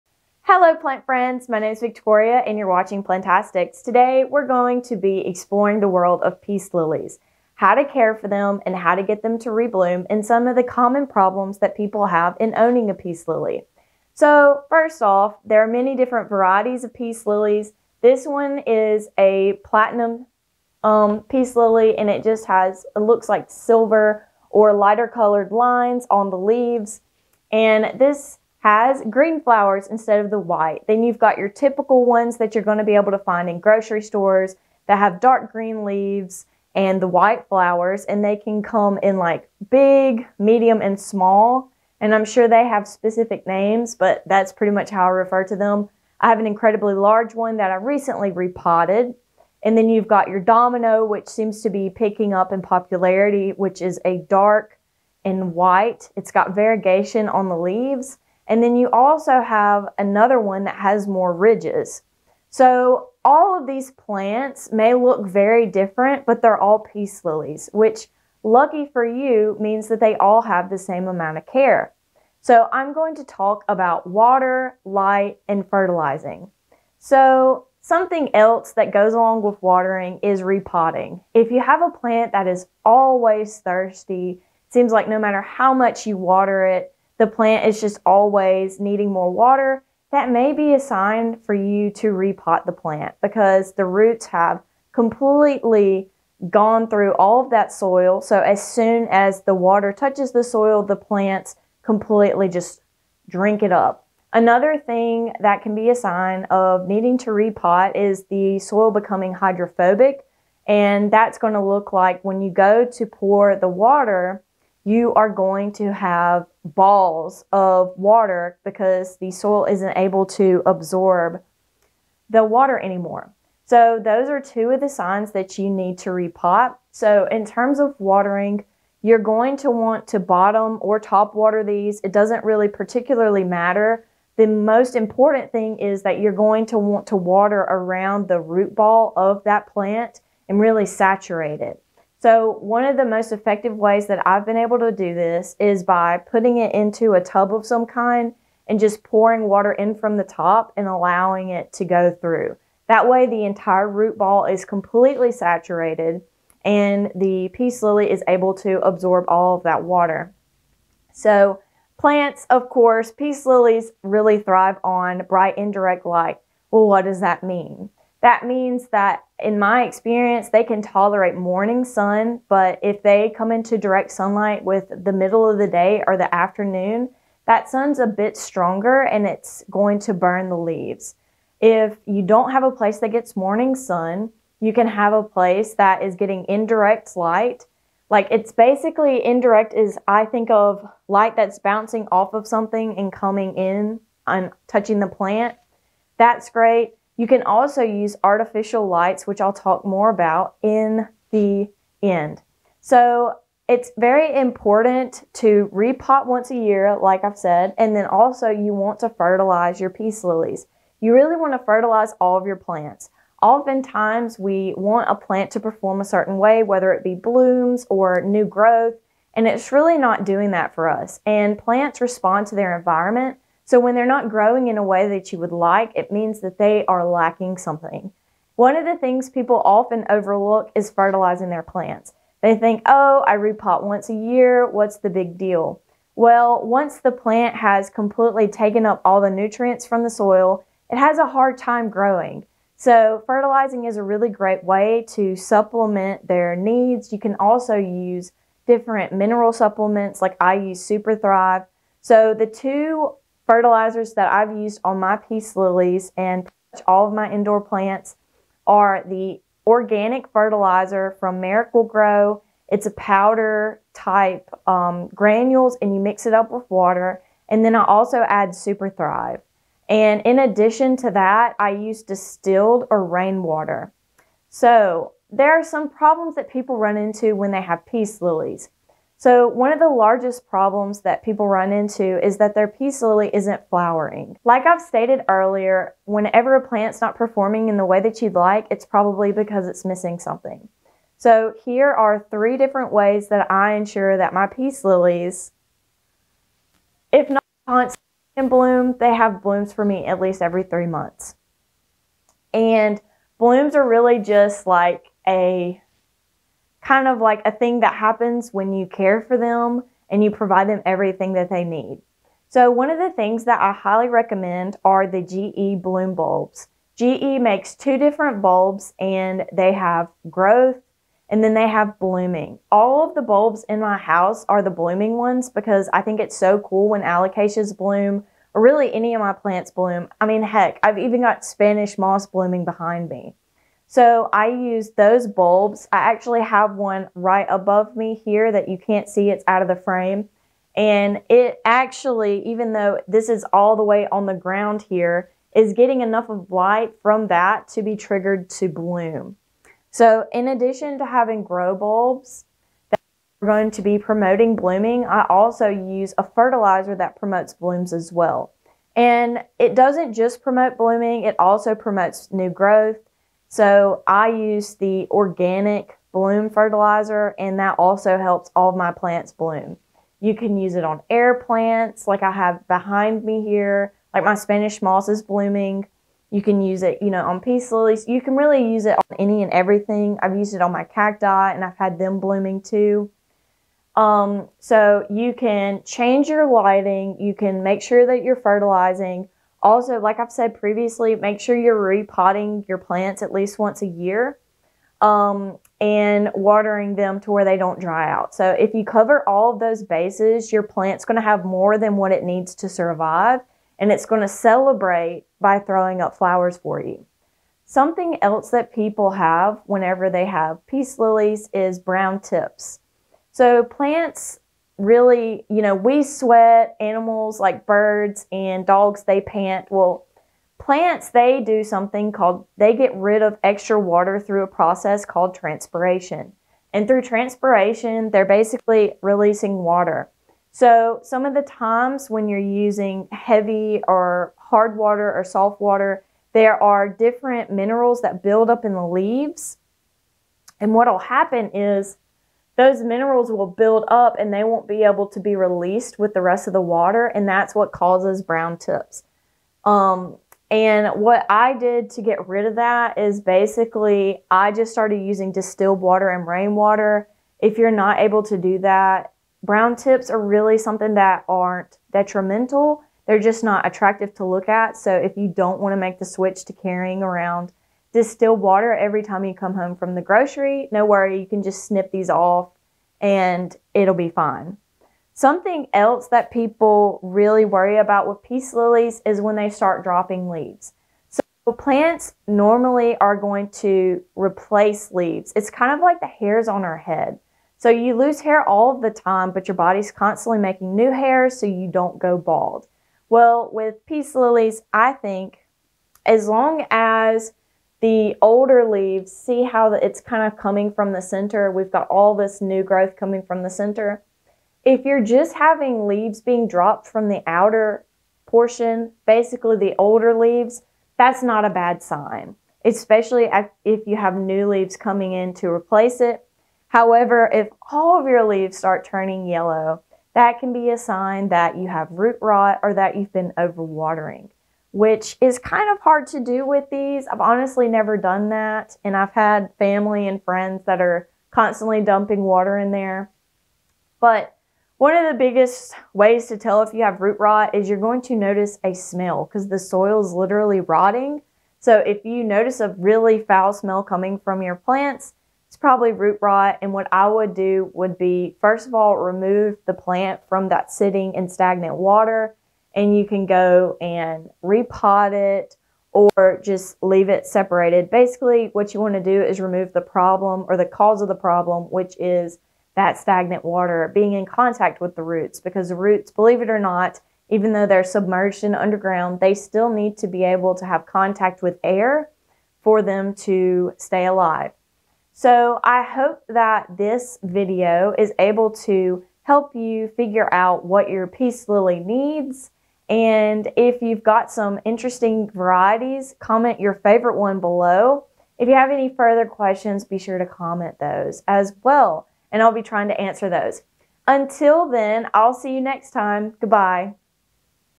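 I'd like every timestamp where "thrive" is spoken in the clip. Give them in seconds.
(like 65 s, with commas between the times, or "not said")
164 s, 251 s, 268 s.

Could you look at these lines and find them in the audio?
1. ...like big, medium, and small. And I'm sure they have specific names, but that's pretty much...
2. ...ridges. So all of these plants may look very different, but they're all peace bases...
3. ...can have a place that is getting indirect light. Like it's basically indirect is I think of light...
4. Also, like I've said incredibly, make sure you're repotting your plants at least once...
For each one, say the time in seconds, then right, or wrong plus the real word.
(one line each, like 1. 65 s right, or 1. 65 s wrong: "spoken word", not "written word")
1. 39 s right
2. 61 s wrong: "lilies", not "bases"
3. 184 s right
4. 389 s wrong: "previously", not "incredibly".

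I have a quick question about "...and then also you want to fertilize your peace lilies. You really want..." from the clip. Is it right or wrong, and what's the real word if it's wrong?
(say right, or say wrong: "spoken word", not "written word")
right.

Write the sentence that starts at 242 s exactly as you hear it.
So, fertilizing is a really great way to supplement their needs.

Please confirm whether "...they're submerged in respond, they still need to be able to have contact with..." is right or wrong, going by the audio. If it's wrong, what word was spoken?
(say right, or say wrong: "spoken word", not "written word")
wrong: "underground", not "respond".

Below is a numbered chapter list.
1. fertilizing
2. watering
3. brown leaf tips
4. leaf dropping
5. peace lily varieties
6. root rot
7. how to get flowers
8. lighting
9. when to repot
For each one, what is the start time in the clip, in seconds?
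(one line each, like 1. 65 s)
1. 207 s
2. 127 s
3. 408 s
4. 490 s
5. 20 s
6. 540 s
7. 284 s
8. 161 s
9. 80 s.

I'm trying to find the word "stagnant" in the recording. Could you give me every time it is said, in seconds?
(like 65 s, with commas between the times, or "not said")
551 s, 562 s.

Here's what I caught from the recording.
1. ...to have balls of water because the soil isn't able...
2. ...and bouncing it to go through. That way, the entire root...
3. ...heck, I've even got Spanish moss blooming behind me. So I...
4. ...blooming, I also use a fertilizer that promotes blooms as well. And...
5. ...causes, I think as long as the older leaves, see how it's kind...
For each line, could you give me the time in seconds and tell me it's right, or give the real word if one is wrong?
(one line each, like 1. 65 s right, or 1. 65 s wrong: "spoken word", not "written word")
1. 115 s right
2. 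150 s wrong: "allowing", not "bouncing"
3. 330 s right
4. 354 s right
5. 494 s wrong: "lilies", not "causes".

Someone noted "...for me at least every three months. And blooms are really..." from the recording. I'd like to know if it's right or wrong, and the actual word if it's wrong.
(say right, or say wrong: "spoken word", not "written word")
right.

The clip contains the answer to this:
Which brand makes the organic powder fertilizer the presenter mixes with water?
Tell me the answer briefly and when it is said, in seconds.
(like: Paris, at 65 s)
Miracle-Gro, at 261 s.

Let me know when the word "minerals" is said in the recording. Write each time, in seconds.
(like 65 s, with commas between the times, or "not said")
249 s, 437 s, 442 s.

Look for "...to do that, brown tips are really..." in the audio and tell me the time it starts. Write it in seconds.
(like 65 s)
458 s.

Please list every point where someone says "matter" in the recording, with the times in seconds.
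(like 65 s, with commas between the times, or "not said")
85 s, 133 s.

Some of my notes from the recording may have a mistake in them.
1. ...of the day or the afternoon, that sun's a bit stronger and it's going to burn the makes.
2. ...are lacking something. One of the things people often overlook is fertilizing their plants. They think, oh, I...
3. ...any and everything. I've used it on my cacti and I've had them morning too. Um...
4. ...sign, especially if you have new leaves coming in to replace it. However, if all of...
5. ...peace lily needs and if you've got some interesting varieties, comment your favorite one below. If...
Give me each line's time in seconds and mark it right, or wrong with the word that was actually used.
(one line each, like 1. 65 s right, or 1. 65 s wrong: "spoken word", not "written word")
1. 175 s wrong: "leaves", not "makes"
2. 226 s right
3. 379 s wrong: "blooming", not "morning"
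4. 511 s right
5. 581 s right.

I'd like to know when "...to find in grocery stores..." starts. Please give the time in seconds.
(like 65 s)
33 s.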